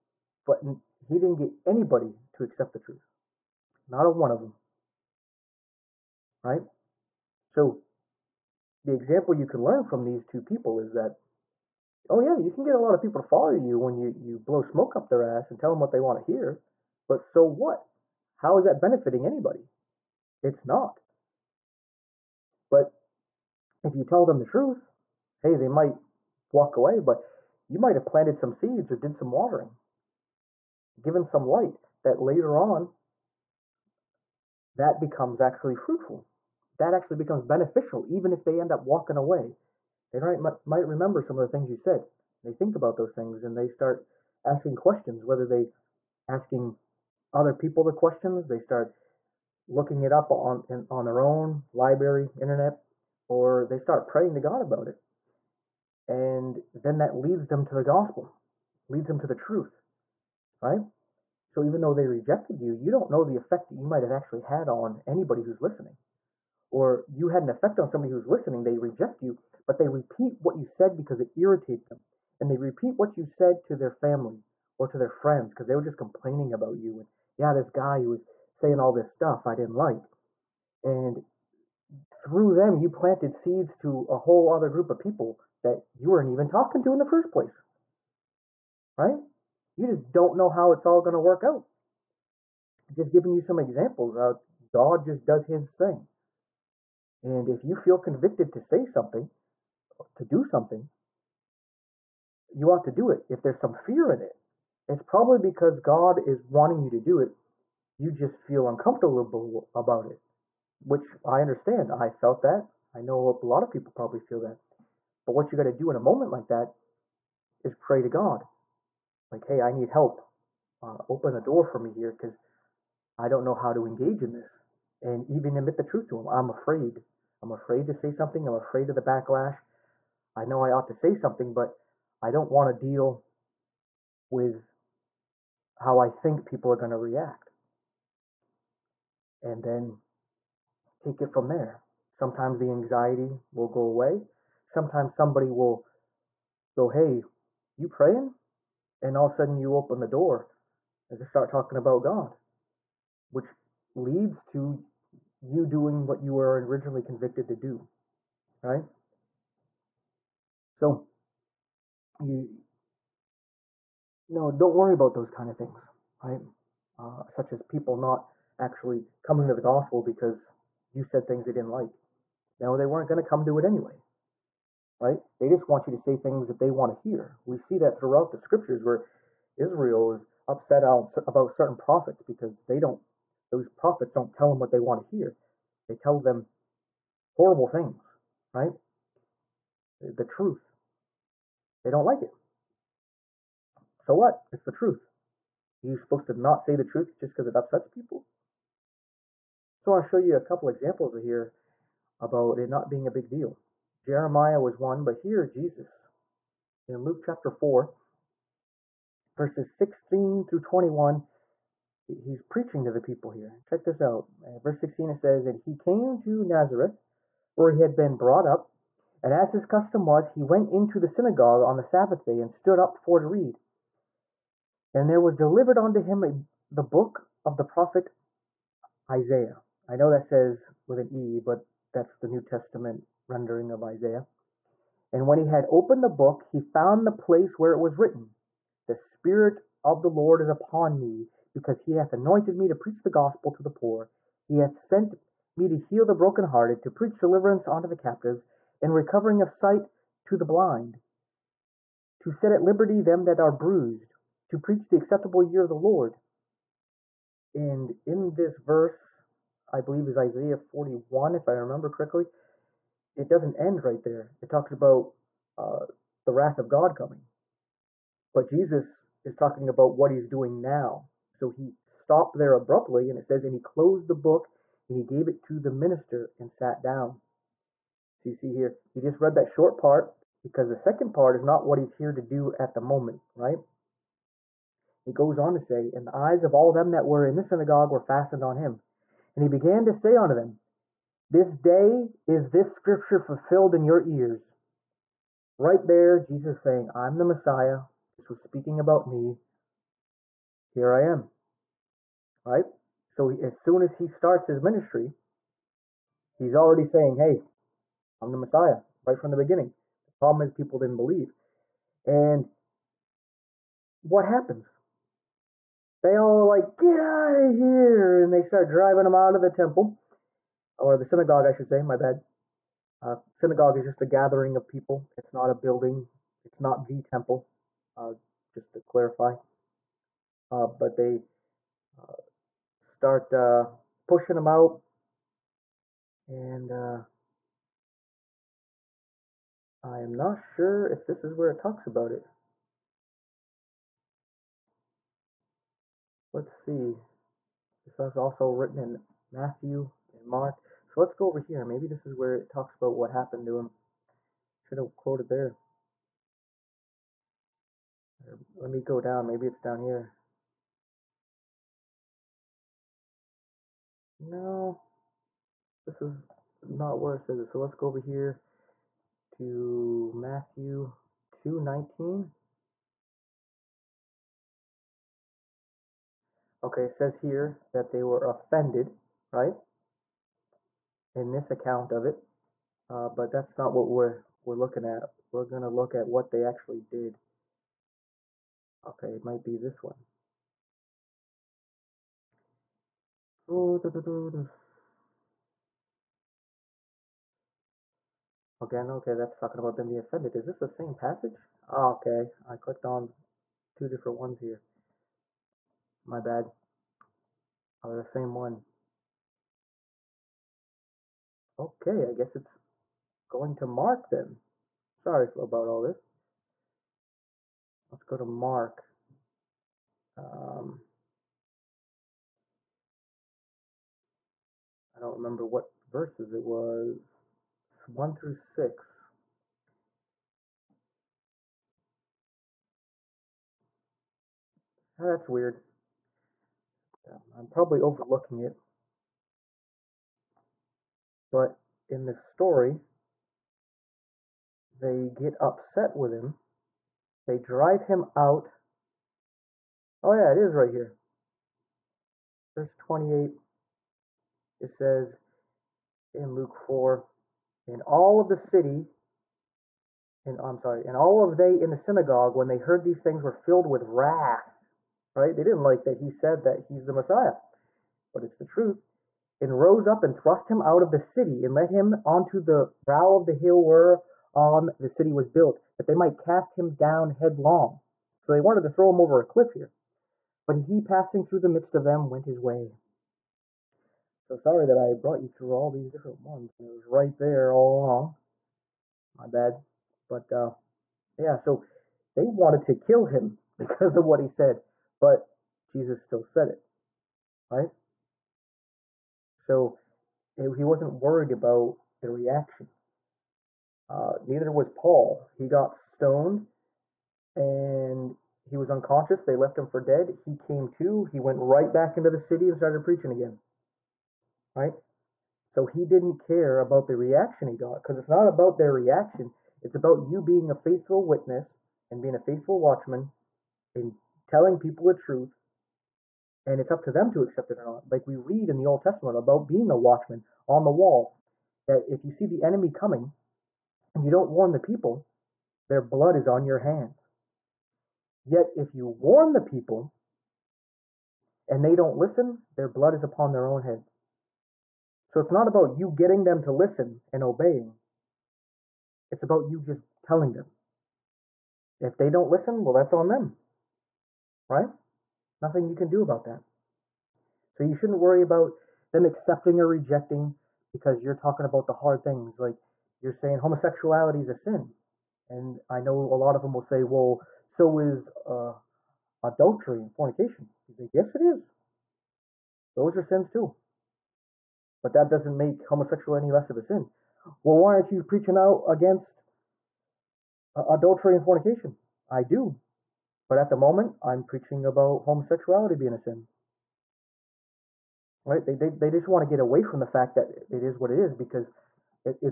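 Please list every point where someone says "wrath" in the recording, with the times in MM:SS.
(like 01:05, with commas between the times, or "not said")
04:26, 07:43.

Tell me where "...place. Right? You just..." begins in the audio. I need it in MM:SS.
01:27.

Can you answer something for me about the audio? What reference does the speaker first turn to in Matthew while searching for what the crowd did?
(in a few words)
Matthew 2:19.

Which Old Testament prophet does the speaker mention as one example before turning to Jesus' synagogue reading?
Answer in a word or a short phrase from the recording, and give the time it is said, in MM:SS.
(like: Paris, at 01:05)
Jeremiah, at 03:24.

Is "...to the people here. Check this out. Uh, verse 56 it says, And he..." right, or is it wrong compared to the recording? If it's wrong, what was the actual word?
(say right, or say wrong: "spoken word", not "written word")
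wrong: "16", not "56".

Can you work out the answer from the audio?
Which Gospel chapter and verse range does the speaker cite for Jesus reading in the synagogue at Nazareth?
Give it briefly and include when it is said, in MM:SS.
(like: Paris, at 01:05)
Luke 4:16-21, at 03:27.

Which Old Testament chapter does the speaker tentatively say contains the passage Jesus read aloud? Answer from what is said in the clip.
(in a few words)
Isaiah 41.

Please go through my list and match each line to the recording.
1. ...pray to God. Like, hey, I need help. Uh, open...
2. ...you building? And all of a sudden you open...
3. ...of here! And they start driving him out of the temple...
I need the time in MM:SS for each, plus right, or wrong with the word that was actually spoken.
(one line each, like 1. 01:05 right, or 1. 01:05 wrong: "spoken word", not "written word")
1. 01:57 right
2. 02:27 wrong: "praying", not "building"
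3. 05:17 right.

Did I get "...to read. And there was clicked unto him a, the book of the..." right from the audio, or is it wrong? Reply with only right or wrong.
wrong.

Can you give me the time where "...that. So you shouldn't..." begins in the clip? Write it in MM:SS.
09:16.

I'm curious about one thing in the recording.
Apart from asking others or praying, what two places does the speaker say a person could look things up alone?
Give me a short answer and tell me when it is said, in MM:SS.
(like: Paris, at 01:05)
library, internet, at 00:51.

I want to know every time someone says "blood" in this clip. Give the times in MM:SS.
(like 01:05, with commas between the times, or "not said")
08:55, 09:02.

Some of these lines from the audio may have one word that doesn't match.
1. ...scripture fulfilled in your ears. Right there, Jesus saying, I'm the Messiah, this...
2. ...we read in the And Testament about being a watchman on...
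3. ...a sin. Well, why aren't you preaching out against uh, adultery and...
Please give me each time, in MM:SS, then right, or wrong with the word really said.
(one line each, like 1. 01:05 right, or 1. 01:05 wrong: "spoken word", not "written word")
1. 04:52 right
2. 08:48 wrong: "Old", not "And"
3. 09:36 right.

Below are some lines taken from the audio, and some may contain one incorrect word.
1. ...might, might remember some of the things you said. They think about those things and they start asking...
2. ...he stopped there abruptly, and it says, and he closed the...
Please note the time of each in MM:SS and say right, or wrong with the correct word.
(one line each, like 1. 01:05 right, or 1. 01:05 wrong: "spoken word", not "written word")
1. 00:40 right
2. 04:31 right.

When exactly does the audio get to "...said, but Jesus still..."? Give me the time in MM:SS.
08:14.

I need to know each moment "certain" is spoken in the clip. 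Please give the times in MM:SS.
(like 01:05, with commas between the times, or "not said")
03:01.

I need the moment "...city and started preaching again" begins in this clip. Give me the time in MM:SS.
08:32.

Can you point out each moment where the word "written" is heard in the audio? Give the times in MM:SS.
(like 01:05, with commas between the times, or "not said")
03:57, 05:48.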